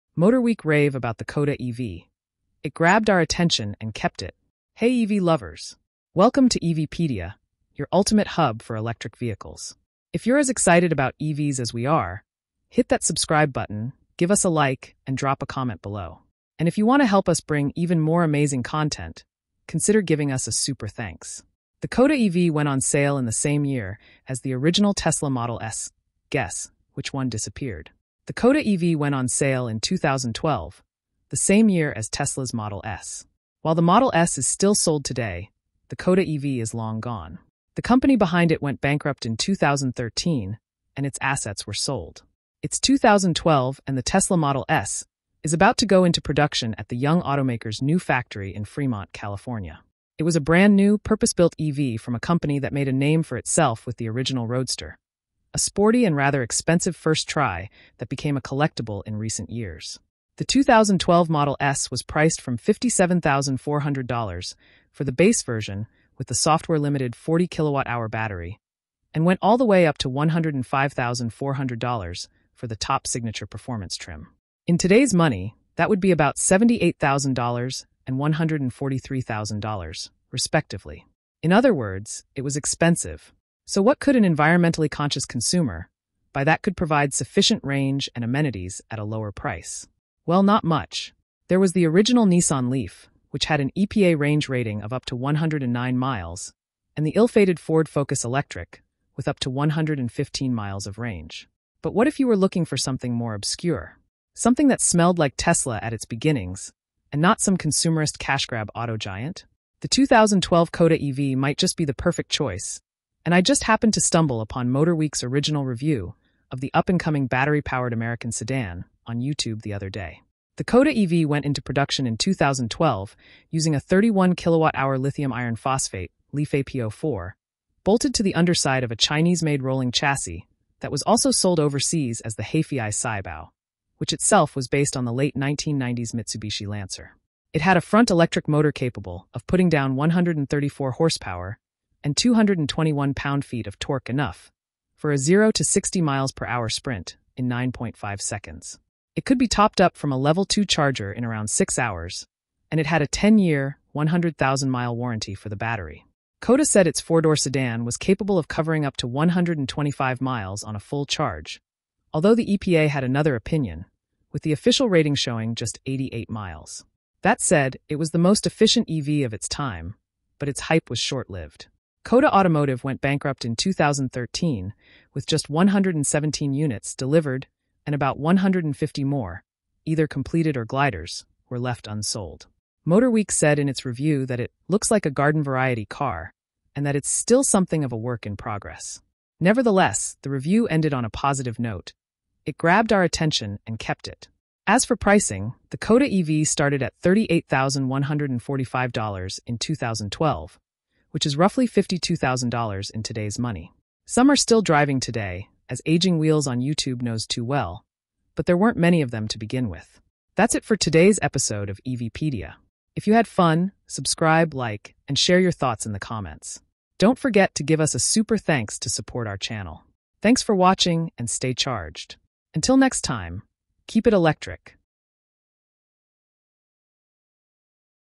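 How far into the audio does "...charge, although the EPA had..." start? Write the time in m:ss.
2:41.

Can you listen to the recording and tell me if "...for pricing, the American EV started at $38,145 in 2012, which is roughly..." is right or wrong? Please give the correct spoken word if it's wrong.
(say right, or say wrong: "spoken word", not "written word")
wrong: "Coda", not "American".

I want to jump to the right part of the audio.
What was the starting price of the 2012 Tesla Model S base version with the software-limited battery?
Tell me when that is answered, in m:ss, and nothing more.
1:02.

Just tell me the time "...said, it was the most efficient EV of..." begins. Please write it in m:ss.
2:47.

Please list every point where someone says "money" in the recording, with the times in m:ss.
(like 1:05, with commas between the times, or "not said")
1:15, 3:23.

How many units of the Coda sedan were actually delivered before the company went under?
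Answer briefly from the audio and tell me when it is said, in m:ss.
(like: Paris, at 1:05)
117, at 2:55.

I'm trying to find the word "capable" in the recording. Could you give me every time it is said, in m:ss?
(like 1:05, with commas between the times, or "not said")
2:18, 2:37.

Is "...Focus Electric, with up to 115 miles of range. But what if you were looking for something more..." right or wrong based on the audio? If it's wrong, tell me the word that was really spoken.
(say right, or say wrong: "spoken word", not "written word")
right.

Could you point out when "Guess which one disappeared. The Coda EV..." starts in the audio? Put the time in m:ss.
0:26.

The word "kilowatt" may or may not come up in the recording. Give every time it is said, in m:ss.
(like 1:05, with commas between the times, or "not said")
1:07, 2:04.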